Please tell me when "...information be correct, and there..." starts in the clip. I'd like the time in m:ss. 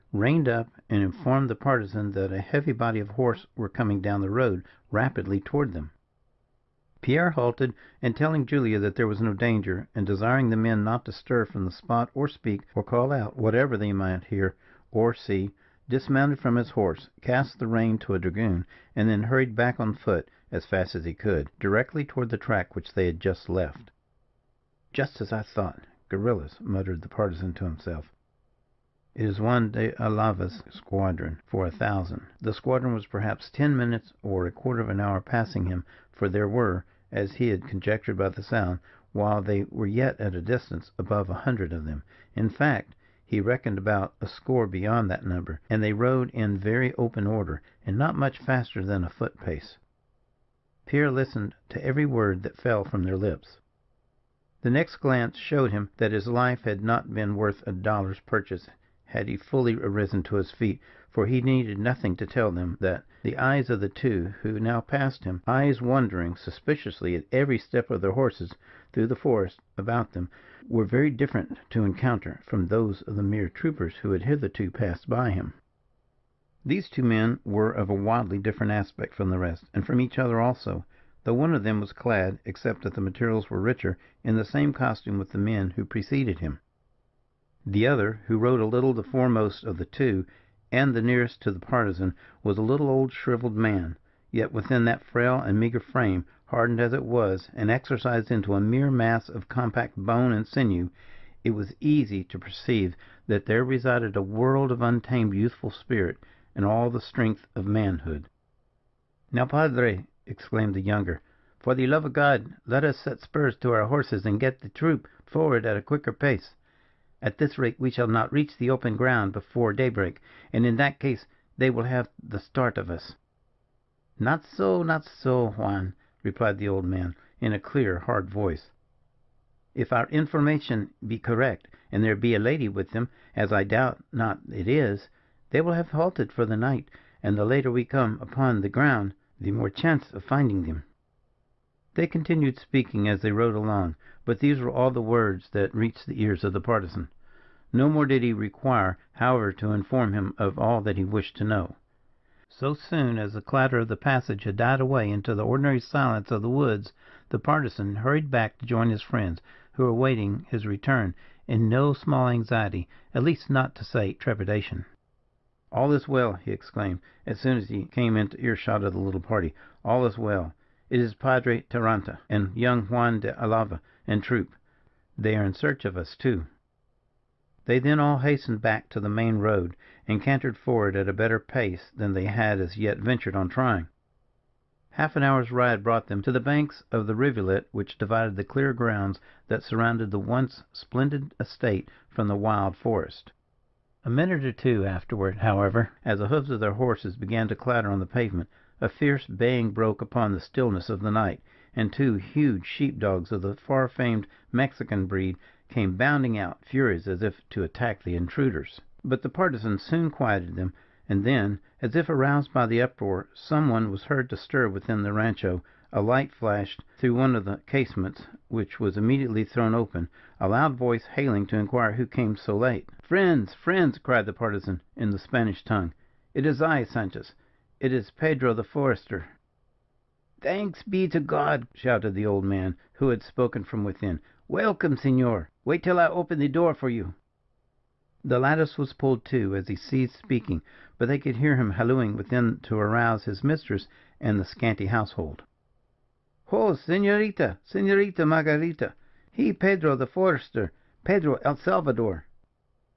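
2:10.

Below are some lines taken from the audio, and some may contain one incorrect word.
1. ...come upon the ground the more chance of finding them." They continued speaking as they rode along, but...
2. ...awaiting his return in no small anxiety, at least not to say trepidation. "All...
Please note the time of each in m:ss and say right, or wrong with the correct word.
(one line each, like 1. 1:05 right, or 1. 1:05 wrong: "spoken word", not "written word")
1. 2:17 right
2. 2:39 right.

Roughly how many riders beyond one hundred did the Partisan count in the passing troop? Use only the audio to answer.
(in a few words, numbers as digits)
a score (20).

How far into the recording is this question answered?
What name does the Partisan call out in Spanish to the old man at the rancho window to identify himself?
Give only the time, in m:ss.
3:46.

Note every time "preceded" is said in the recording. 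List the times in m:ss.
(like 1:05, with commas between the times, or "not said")
1:25.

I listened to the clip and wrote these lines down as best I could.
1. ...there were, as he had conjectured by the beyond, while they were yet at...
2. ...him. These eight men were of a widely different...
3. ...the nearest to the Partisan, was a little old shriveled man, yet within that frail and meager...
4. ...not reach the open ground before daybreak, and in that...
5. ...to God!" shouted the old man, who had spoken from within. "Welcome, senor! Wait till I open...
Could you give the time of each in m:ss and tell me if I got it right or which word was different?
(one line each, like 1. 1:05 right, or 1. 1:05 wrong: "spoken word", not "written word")
1. 0:36 wrong: "sound", not "beyond"
2. 1:15 wrong: "two", not "eight"
3. 1:30 right
4. 1:58 right
5. 3:51 right.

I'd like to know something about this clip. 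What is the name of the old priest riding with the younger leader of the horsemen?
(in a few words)
Padre Jarauta.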